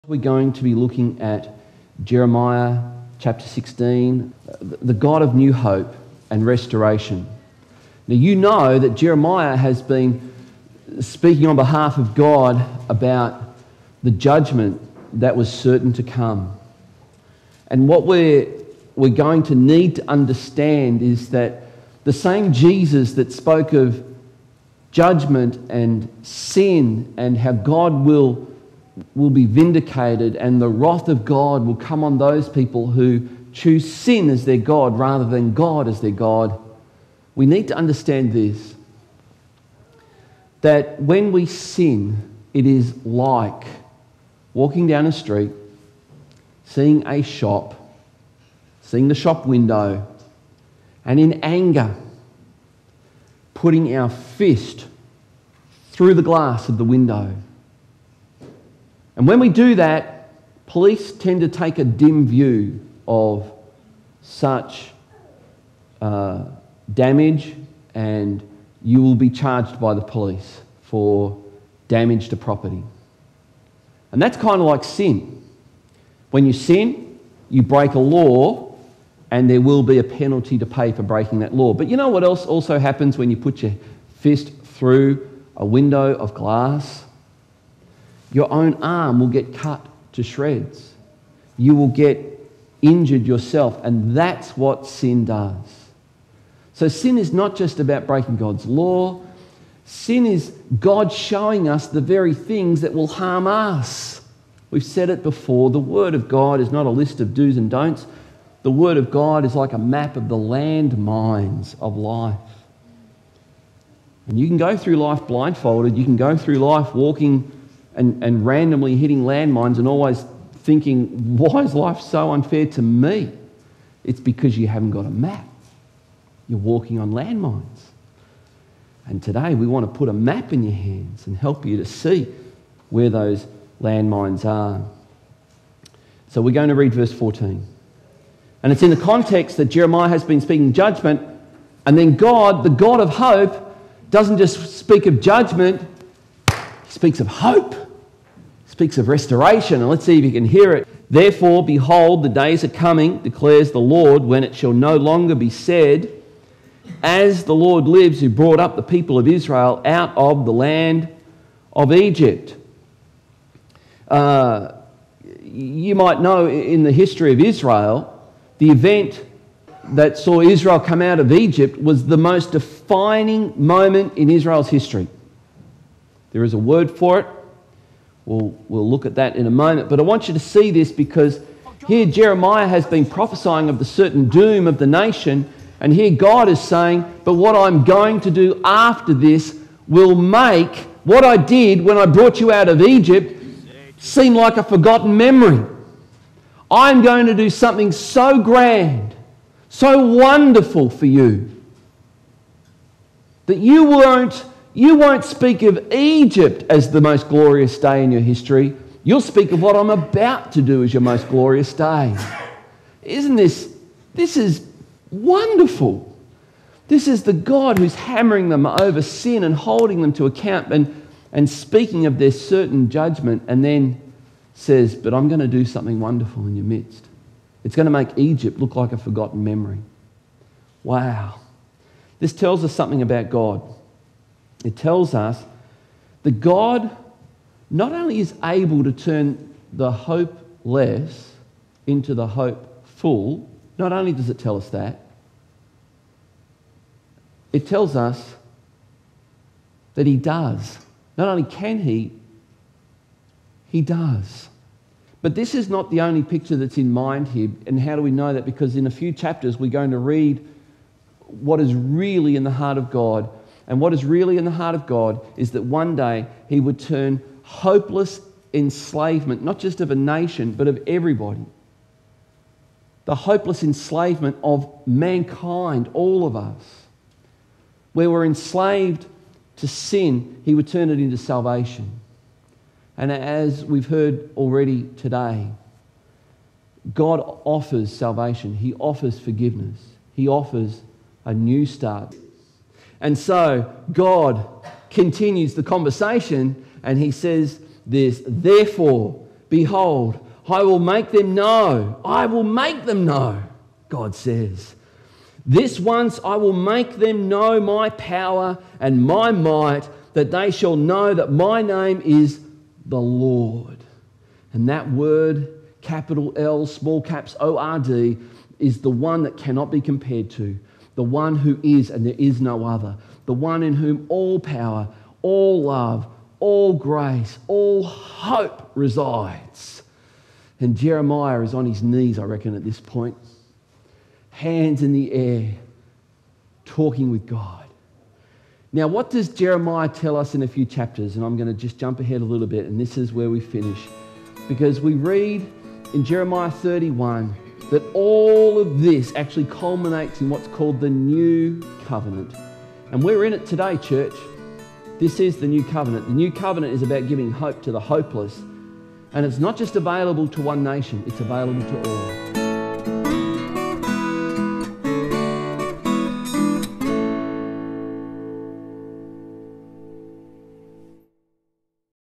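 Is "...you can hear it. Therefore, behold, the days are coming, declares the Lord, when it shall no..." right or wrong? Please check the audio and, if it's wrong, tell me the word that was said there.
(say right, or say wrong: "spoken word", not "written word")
right.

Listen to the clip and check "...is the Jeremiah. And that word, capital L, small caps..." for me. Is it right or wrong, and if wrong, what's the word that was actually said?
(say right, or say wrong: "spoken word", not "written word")
wrong: "Lord", not "Jeremiah".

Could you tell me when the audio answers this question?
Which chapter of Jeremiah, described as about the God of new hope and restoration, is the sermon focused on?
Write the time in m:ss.
0:03.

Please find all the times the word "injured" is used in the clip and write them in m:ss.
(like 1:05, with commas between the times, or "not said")
1:32.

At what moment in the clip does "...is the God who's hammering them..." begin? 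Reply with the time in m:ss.
3:37.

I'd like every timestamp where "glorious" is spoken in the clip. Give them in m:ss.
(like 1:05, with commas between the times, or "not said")
3:27, 3:31.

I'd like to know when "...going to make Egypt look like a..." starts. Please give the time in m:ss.
3:47.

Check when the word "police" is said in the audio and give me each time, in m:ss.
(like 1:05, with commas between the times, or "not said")
1:00, 1:10.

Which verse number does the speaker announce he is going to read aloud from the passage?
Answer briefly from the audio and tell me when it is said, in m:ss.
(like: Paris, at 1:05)
14, at 2:16.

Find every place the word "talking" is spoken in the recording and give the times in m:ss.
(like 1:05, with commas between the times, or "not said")
5:36.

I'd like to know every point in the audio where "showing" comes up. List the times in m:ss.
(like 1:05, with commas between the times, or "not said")
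1:41.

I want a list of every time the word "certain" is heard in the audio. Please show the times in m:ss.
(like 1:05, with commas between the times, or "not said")
0:15, 3:03, 3:42.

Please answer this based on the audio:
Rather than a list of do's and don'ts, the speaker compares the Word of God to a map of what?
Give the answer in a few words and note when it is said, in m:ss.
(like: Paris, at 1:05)
Landmines of life, at 1:50.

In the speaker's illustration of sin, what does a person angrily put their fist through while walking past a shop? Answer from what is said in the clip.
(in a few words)
The shop window.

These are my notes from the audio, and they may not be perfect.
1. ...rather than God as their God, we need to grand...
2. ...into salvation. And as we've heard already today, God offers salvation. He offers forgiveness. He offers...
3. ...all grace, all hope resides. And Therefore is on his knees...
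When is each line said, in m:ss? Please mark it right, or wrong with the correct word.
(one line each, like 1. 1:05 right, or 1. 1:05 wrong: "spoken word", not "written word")
1. 0:34 wrong: "understand", not "grand"
2. 4:40 right
3. 5:26 wrong: "Jeremiah", not "Therefore".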